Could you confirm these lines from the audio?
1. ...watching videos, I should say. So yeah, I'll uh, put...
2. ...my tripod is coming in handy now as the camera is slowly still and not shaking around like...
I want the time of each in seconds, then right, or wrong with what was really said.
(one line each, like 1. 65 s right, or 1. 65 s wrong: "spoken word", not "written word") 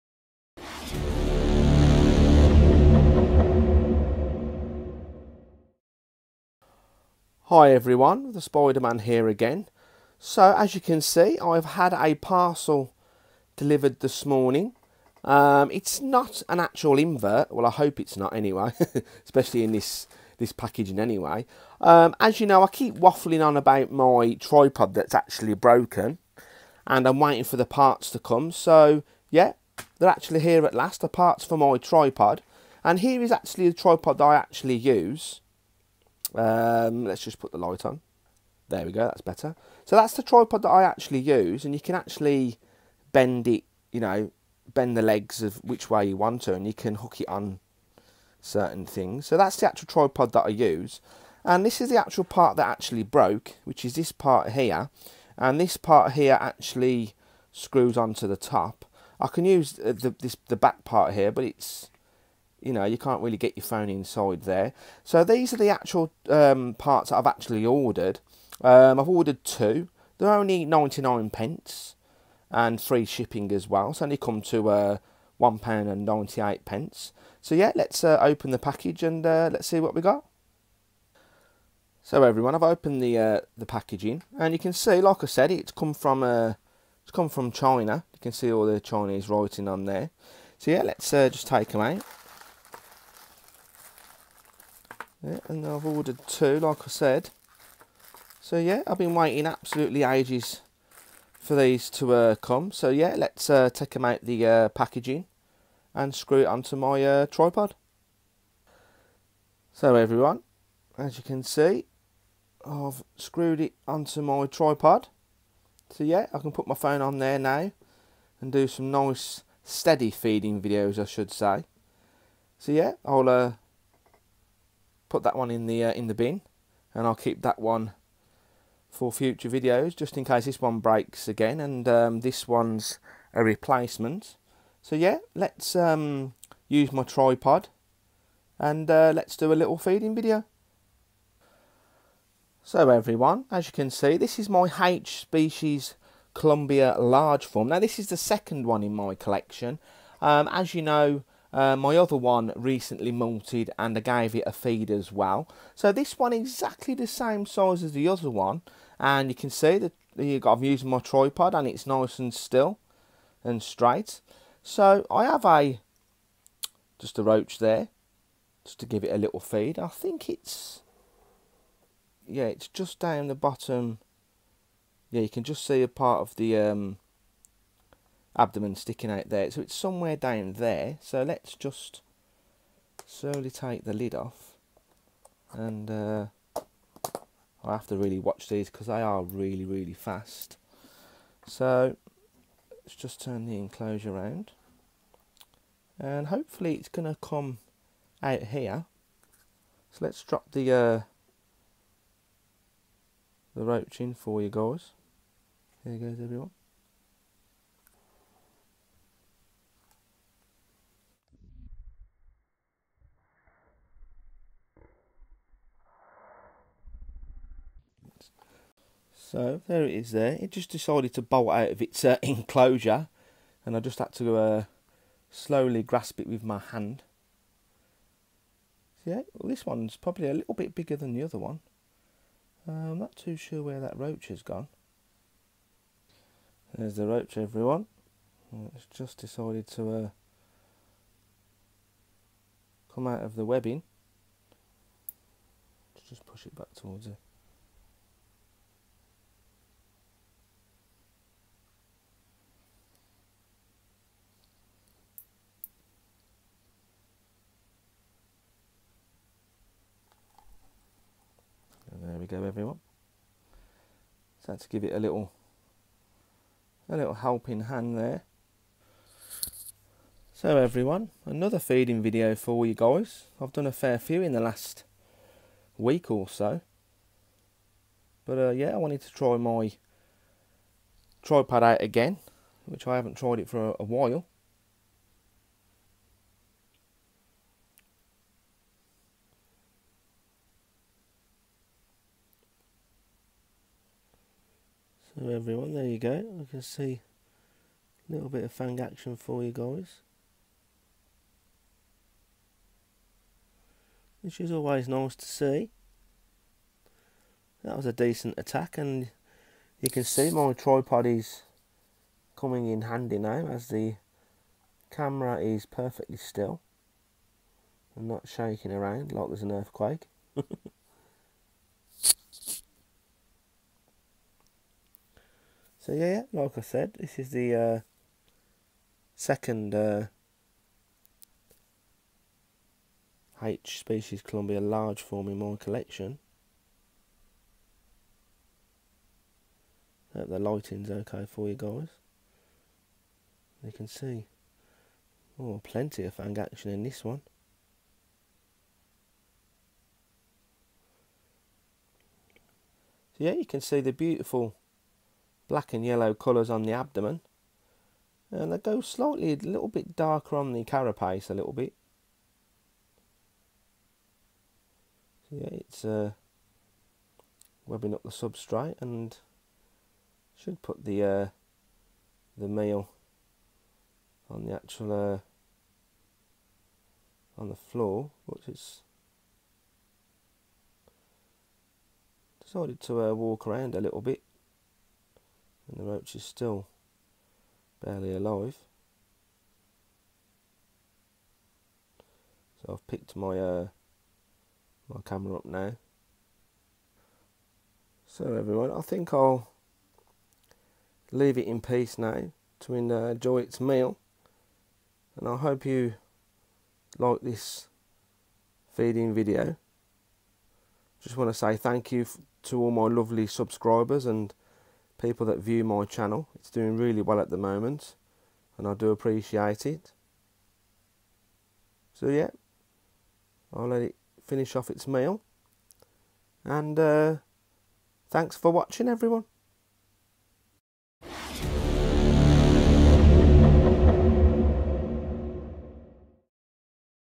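1. 120 s wrong: "feeding", not "watching"
2. 310 s wrong: "perfectly", not "slowly".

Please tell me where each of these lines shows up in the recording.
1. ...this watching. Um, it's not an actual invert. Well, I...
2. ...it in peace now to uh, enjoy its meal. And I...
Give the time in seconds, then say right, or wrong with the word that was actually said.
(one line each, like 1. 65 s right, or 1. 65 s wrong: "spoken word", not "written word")
1. 13 s wrong: "morning", not "watching"
2. 401 s right.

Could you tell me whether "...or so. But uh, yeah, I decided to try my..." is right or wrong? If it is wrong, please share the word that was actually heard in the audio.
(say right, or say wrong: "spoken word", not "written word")
wrong: "wanted", not "decided".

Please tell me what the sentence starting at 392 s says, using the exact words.
So I've picked my uh, my camera up now.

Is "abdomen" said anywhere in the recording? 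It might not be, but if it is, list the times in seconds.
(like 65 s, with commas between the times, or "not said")
178 s, 356 s.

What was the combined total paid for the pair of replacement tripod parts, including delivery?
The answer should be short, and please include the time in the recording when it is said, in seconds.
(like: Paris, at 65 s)
£1.98, at 75 s.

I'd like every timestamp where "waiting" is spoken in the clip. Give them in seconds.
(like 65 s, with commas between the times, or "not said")
27 s, 99 s.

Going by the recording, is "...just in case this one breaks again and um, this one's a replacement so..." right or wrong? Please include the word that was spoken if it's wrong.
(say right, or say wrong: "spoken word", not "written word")
right.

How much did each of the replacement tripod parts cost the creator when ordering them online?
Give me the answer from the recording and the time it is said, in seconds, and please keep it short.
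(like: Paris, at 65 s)
99 pence, at 70 s.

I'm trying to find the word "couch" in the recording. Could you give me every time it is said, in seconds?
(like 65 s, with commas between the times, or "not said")
not said.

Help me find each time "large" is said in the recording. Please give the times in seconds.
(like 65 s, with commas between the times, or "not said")
146 s, 334 s.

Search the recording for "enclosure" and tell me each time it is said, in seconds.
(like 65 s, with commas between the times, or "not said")
193 s, 222 s.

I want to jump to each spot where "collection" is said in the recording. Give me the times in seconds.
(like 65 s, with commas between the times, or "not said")
149 s, 335 s.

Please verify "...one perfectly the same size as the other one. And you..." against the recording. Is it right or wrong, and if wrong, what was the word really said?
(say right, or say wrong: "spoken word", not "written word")
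wrong: "exactly", not "perfectly".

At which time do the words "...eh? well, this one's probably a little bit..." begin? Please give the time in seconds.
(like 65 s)
229 s.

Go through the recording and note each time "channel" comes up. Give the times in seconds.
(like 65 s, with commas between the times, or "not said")
415 s.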